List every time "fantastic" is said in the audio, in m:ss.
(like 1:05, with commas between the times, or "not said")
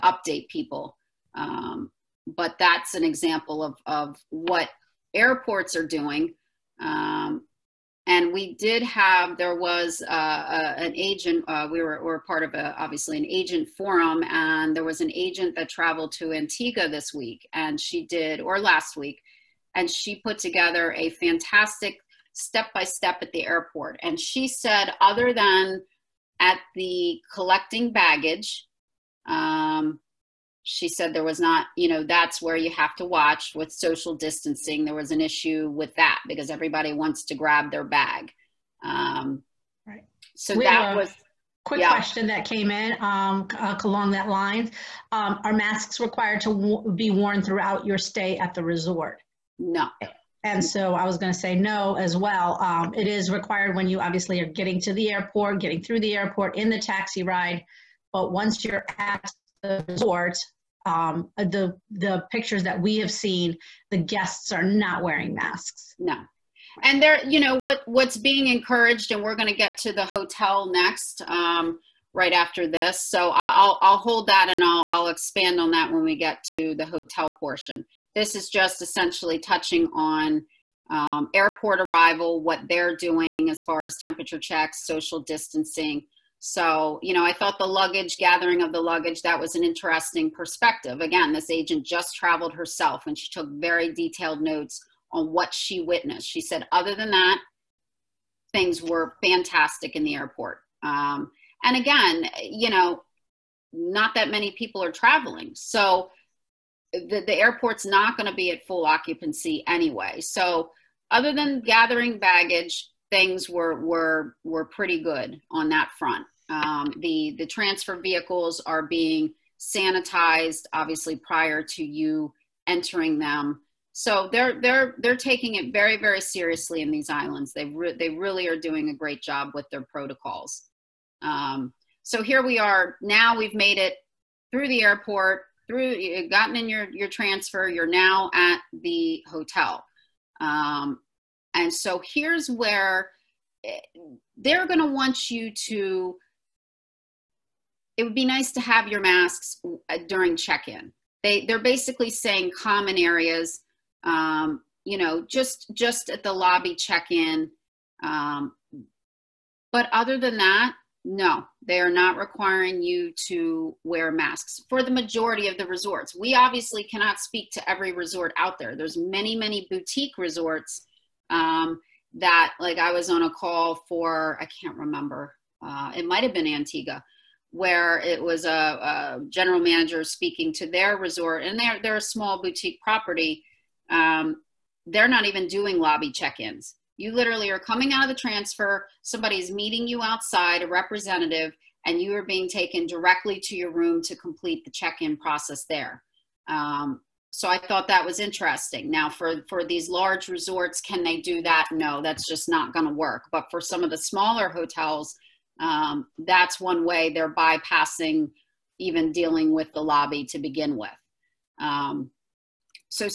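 0:21, 1:39.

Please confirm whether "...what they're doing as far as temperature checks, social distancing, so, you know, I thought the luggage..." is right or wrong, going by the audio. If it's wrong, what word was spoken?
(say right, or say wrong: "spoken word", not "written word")
right.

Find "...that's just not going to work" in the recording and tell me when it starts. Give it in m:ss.
3:22.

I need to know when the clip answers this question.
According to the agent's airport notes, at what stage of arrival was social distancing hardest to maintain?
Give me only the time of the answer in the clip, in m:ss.
0:27.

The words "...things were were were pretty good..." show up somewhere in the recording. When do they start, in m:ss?
1:53.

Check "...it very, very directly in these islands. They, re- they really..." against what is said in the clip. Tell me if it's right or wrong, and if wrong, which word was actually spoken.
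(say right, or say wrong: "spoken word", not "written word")
wrong: "seriously", not "directly".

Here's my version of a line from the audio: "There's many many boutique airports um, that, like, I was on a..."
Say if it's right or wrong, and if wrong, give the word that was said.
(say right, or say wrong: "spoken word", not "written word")
wrong: "resorts", not "airports".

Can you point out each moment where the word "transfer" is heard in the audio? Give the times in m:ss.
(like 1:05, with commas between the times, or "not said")
1:57, 2:17, 3:08.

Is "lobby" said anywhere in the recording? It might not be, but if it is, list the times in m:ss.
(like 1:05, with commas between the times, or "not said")
2:36, 3:05, 3:29.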